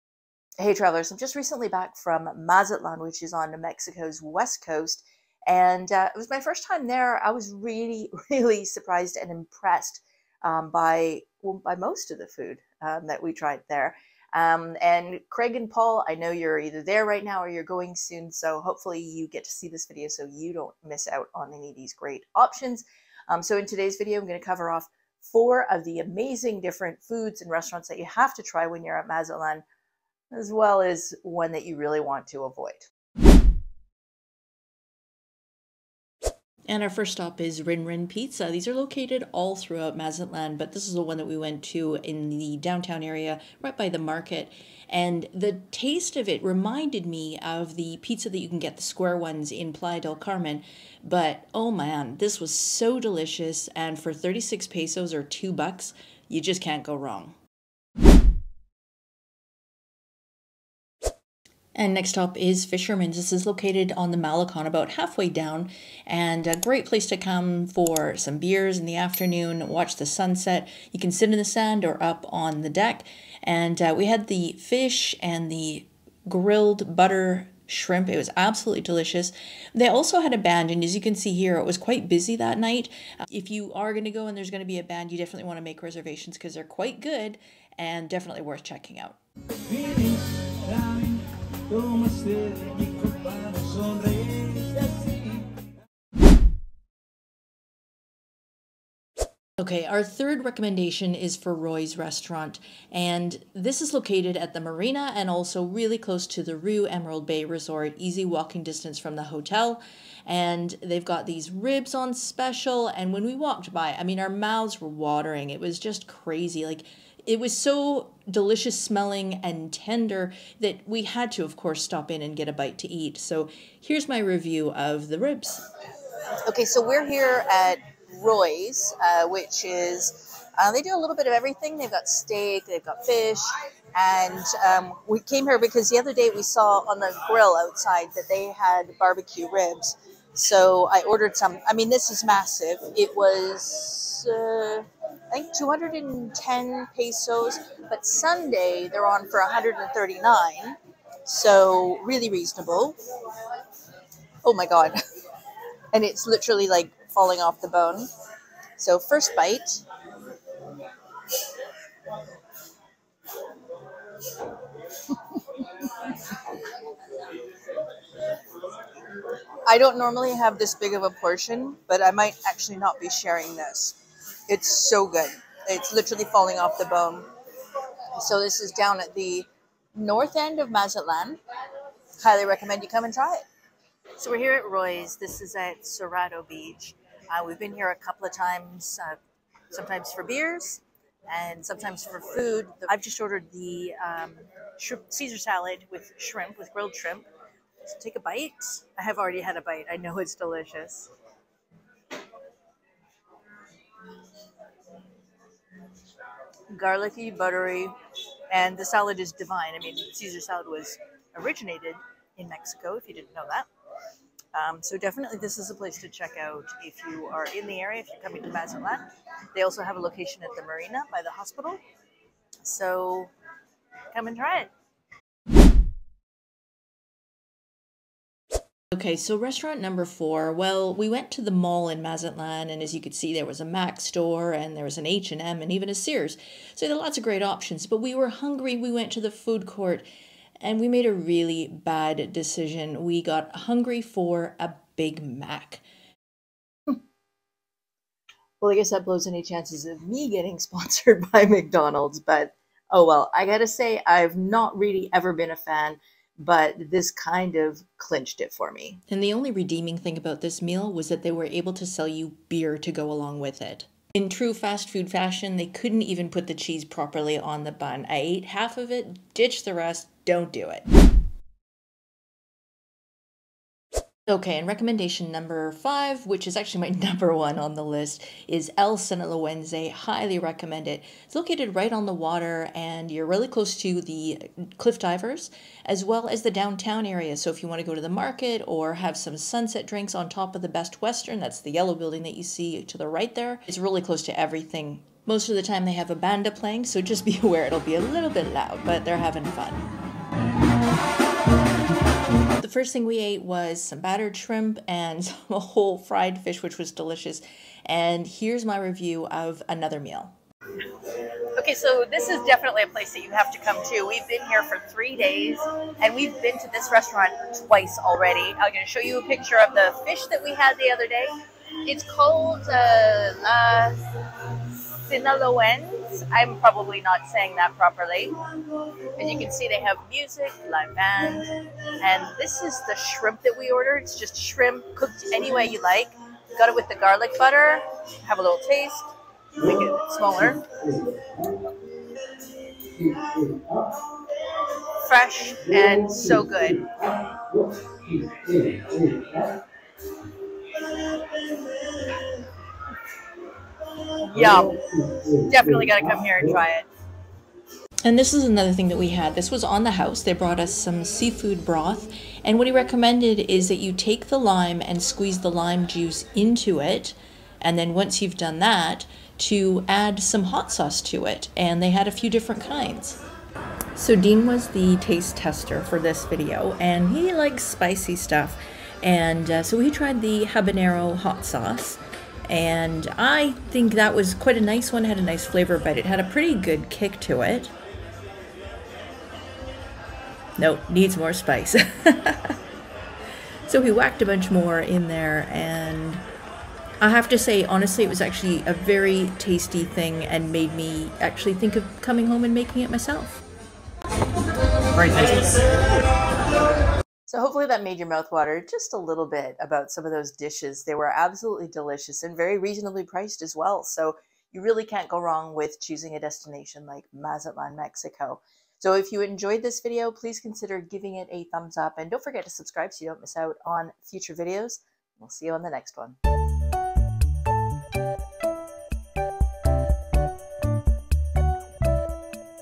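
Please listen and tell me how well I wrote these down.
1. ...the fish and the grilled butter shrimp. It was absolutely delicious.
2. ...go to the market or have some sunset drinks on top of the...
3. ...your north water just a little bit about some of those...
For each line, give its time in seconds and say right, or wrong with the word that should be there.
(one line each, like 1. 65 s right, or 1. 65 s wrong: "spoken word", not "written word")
1. 74 s right
2. 287 s right
3. 407 s wrong: "mouth", not "north".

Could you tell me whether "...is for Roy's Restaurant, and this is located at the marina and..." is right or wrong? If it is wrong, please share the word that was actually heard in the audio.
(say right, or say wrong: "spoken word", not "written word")
right.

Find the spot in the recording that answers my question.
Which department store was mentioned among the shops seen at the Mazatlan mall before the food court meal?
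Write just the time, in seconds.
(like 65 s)
235 s.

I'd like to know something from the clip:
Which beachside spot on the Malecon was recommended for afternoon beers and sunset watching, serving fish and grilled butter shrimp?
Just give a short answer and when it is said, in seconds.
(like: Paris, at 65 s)
Fisherman's, at 62 s.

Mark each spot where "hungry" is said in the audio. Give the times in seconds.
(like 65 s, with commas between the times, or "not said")
238 s, 243 s.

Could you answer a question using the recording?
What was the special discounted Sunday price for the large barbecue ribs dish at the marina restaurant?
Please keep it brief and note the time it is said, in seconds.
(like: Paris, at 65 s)
139 pesos, at 149 s.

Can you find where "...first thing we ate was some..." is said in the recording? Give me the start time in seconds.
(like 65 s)
302 s.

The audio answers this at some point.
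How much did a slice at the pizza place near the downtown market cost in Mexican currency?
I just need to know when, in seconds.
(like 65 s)
54 s.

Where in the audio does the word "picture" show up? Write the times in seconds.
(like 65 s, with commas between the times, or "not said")
319 s.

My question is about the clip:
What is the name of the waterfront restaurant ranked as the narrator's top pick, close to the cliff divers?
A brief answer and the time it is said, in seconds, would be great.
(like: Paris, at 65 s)
El Sinaloense, at 278 s.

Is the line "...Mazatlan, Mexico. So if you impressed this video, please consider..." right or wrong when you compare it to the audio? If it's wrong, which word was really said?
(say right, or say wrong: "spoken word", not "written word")
wrong: "enjoyed", not "impressed".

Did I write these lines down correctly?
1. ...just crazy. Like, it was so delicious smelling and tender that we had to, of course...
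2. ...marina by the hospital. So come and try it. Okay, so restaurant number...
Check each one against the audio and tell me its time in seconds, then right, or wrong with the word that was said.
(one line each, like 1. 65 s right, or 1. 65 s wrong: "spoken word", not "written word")
1. 115 s right
2. 220 s right.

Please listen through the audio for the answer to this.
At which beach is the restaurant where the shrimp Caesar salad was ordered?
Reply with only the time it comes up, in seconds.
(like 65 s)
185 s.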